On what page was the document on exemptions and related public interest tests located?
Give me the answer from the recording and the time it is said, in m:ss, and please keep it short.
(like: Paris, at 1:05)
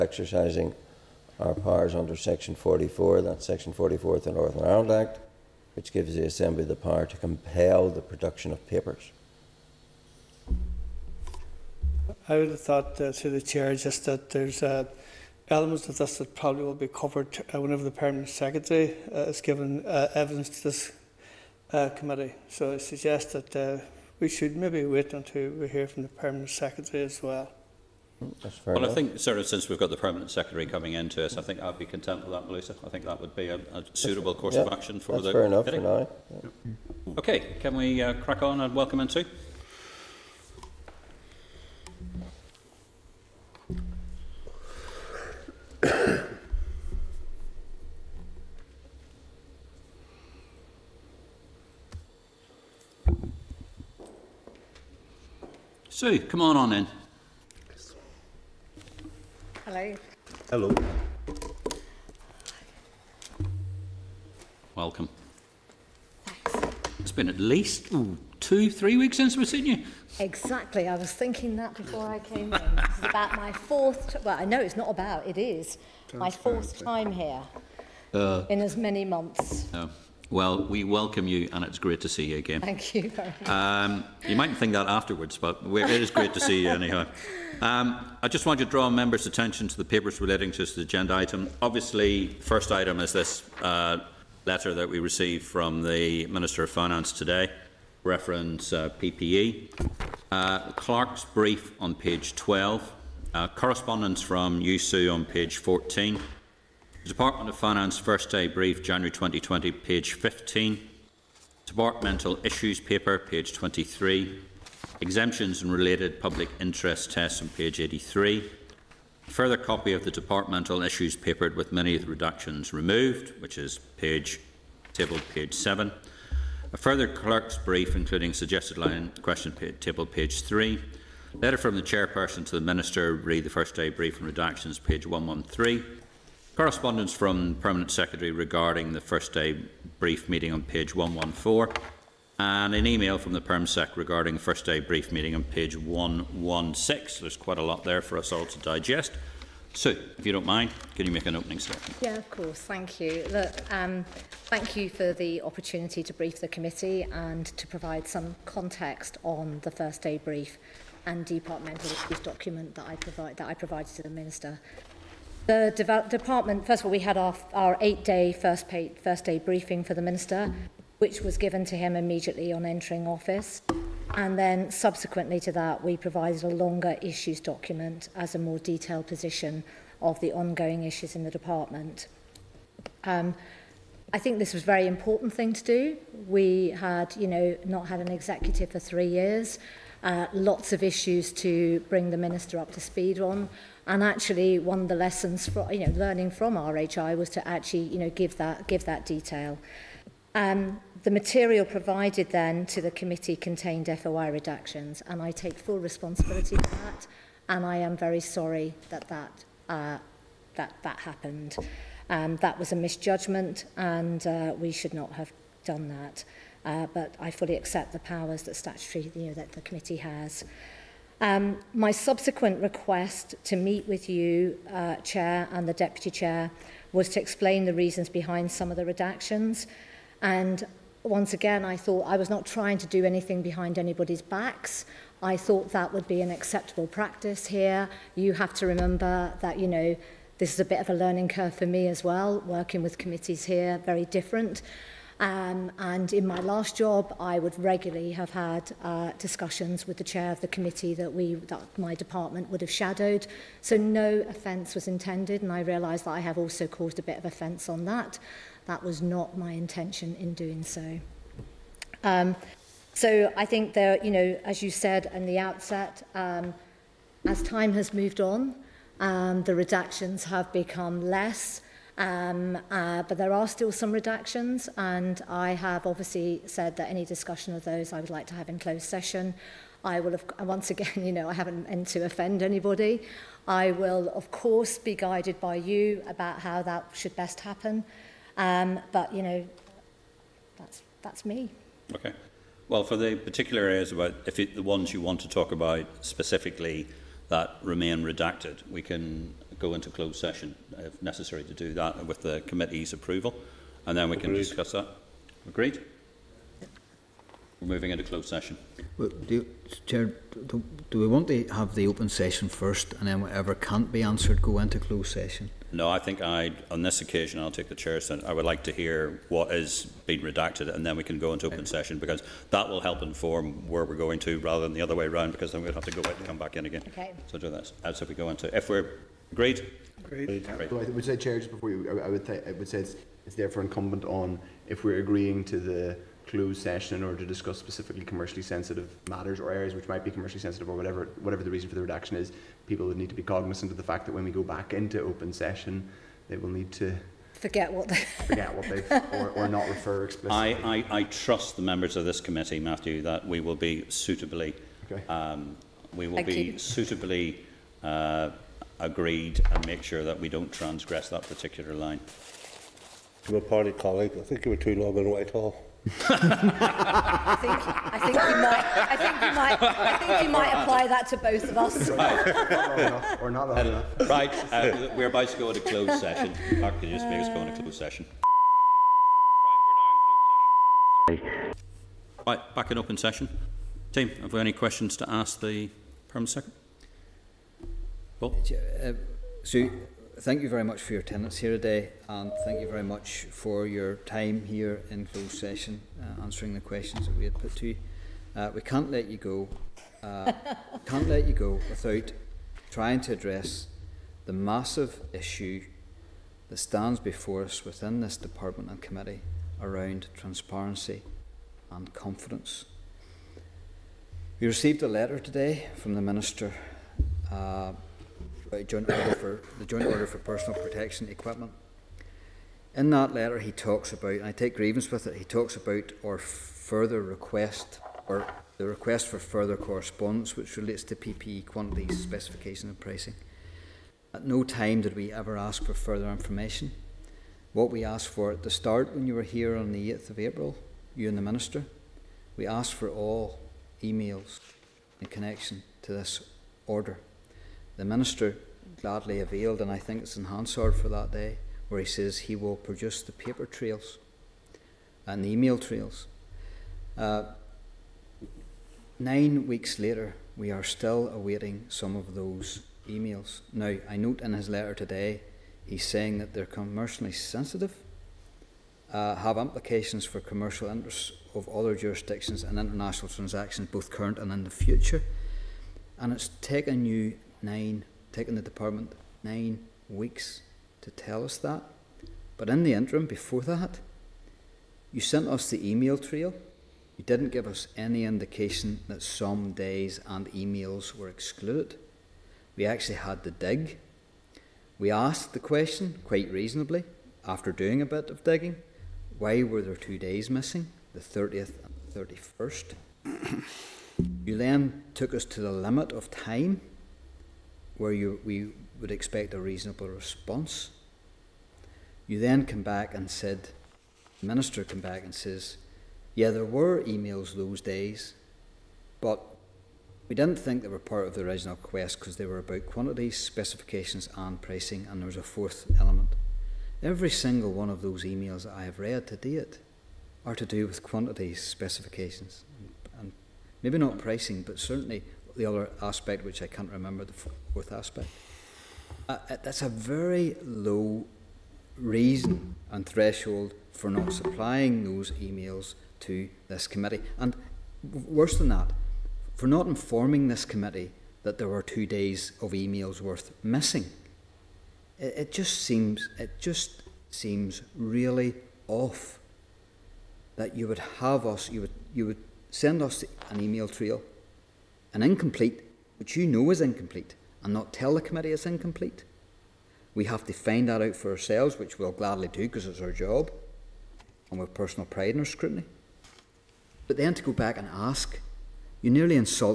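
83, at 1:57.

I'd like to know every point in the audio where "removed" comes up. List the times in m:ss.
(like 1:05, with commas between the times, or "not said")
2:02.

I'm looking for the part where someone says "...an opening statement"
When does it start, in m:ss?
2:31.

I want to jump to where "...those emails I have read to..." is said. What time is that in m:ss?
8:47.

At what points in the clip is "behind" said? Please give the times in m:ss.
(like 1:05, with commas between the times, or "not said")
3:48, 3:53.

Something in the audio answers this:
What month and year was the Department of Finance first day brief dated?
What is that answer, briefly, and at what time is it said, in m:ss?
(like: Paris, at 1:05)
January 2020, at 1:48.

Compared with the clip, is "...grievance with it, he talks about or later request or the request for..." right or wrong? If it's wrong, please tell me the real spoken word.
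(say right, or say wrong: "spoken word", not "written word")
wrong: "further", not "later".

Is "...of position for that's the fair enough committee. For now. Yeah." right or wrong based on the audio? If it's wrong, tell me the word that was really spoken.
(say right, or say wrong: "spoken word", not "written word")
wrong: "action", not "position".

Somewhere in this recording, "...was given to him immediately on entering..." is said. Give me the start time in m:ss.
2:51.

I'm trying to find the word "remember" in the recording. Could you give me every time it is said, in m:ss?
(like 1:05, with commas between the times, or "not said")
3:58, 8:56.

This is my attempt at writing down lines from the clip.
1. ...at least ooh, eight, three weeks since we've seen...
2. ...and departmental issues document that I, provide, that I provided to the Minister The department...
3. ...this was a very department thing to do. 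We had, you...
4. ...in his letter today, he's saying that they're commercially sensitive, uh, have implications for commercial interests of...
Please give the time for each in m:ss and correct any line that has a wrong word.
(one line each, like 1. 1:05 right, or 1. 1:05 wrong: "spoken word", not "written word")
1. 1:07 wrong: "two", not "eight"
2. 2:41 right
3. 3:04 wrong: "important", not "department"
4. 7:44 right.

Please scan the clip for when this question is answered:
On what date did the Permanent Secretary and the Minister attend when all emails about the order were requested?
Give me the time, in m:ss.
7:19.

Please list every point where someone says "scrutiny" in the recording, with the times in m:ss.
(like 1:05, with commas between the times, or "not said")
9:35.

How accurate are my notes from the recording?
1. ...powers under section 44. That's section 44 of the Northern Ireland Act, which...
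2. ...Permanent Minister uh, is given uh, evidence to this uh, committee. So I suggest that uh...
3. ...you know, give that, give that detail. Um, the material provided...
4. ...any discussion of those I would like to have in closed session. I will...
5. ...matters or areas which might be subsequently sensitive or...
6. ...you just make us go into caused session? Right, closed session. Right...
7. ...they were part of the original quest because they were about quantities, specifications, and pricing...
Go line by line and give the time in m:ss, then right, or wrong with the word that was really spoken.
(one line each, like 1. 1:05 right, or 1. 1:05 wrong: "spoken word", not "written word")
1. 0:01 right
2. 0:17 wrong: "Secretary", not "Minister"
3. 3:17 right
4. 4:36 right
5. 5:39 wrong: "commercially", not "subsequently"
6. 6:16 wrong: "closed", not "caused"
7. 8:40 right.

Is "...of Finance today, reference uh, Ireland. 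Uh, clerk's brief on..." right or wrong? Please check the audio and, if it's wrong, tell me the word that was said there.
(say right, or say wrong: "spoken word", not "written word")
wrong: "PPE", not "Ireland".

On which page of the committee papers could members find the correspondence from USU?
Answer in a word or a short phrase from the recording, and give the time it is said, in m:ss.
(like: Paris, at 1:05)
14, at 1:45.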